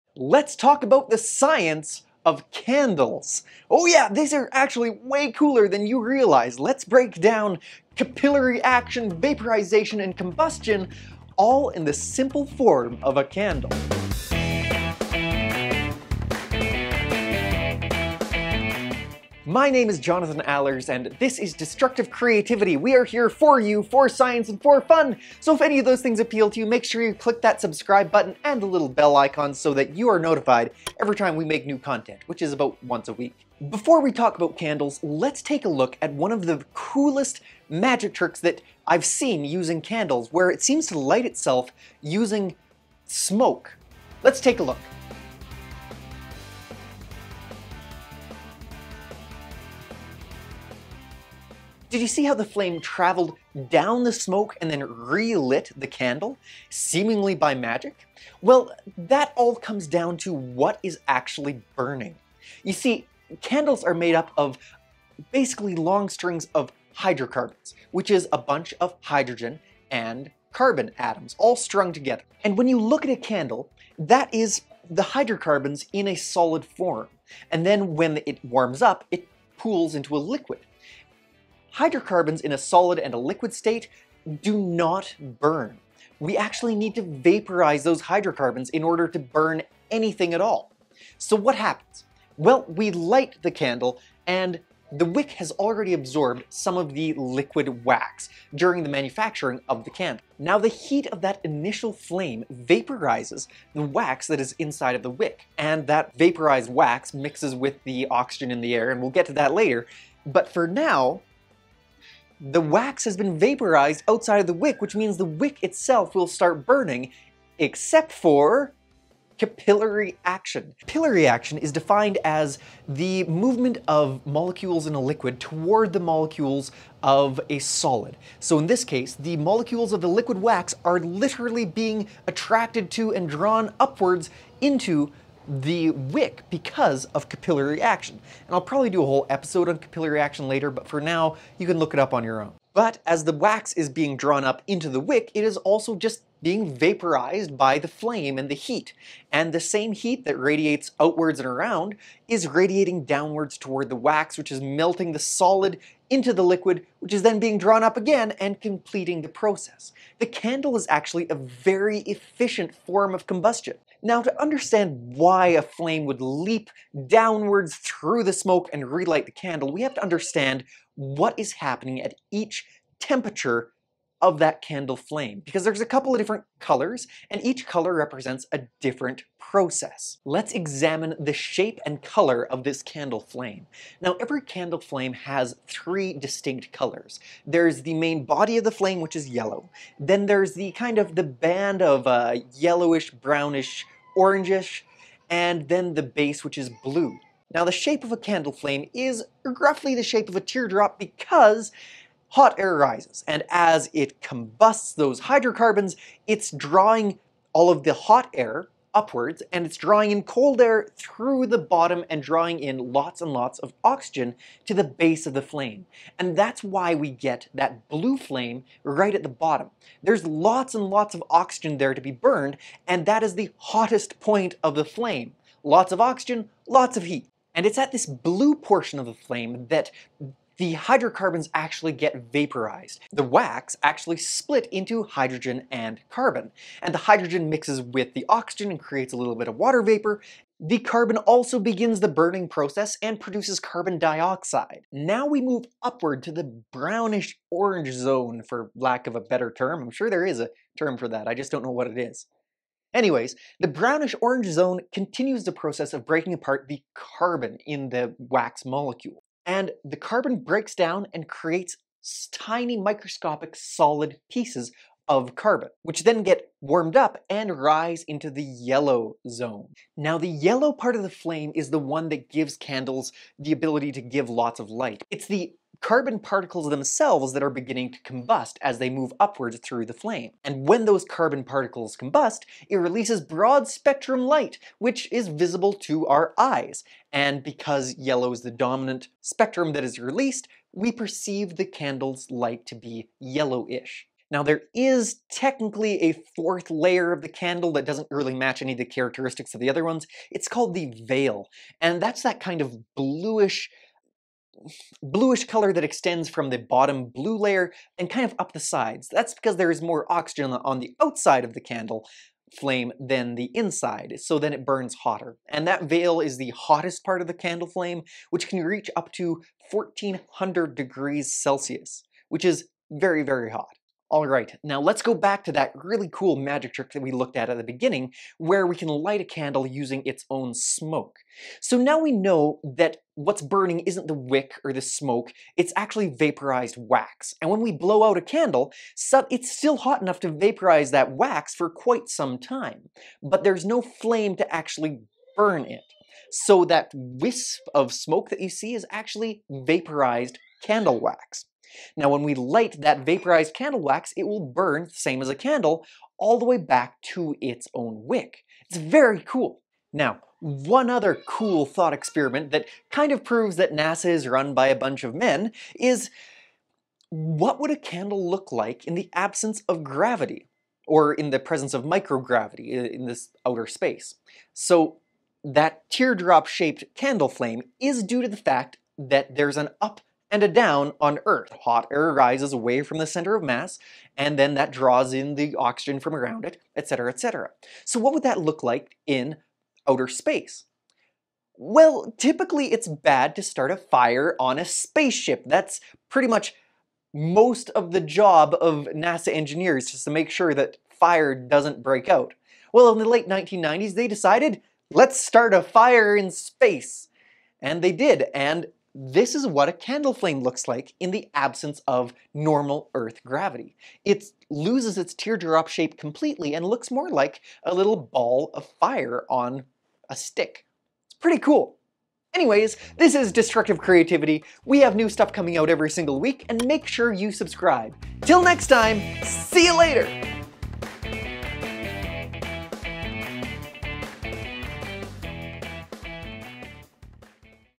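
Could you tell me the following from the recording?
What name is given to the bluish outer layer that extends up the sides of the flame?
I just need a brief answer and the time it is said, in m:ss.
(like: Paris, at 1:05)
the veil, at 5:00.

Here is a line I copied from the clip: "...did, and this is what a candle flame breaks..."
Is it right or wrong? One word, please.
wrong.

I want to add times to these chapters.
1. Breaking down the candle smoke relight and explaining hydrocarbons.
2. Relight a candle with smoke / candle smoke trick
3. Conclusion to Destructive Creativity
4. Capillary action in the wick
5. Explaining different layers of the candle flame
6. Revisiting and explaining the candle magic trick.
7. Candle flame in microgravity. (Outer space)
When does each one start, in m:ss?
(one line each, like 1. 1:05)
1. 1:00
2. 0:33
3. 7:00
4. 1:58
5. 2:45
6. 5:27
7. 6:00.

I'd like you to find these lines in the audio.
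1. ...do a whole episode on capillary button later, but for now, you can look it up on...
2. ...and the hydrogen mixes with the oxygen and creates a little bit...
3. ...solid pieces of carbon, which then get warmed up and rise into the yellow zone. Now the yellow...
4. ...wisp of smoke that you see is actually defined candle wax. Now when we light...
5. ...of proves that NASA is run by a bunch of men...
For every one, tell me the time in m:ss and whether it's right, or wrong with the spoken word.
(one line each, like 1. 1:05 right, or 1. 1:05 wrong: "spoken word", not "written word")
1. 2:18 wrong: "action", not "button"
2. 3:56 right
3. 4:23 right
4. 5:46 wrong: "vaporized", not "defined"
5. 6:03 right.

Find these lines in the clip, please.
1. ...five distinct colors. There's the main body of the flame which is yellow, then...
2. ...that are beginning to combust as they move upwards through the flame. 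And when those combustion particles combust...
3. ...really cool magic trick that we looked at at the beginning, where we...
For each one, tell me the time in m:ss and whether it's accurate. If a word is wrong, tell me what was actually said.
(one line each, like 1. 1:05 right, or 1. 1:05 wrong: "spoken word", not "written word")
1. 3:05 wrong: "three", not "five"
2. 4:37 wrong: "carbon", not "combustion"
3. 5:25 right.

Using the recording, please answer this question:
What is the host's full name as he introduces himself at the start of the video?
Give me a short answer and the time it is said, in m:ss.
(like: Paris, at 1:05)
Jonathan Allers, at 0:19.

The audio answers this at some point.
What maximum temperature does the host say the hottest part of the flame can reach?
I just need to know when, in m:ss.
5:19.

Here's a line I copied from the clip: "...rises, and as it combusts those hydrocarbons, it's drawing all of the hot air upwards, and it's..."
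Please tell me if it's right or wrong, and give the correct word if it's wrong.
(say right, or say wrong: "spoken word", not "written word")
right.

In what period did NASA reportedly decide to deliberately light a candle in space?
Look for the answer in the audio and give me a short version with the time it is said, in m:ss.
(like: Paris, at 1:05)
late 1990s, at 6:43.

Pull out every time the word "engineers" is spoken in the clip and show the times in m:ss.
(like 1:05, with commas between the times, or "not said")
6:39.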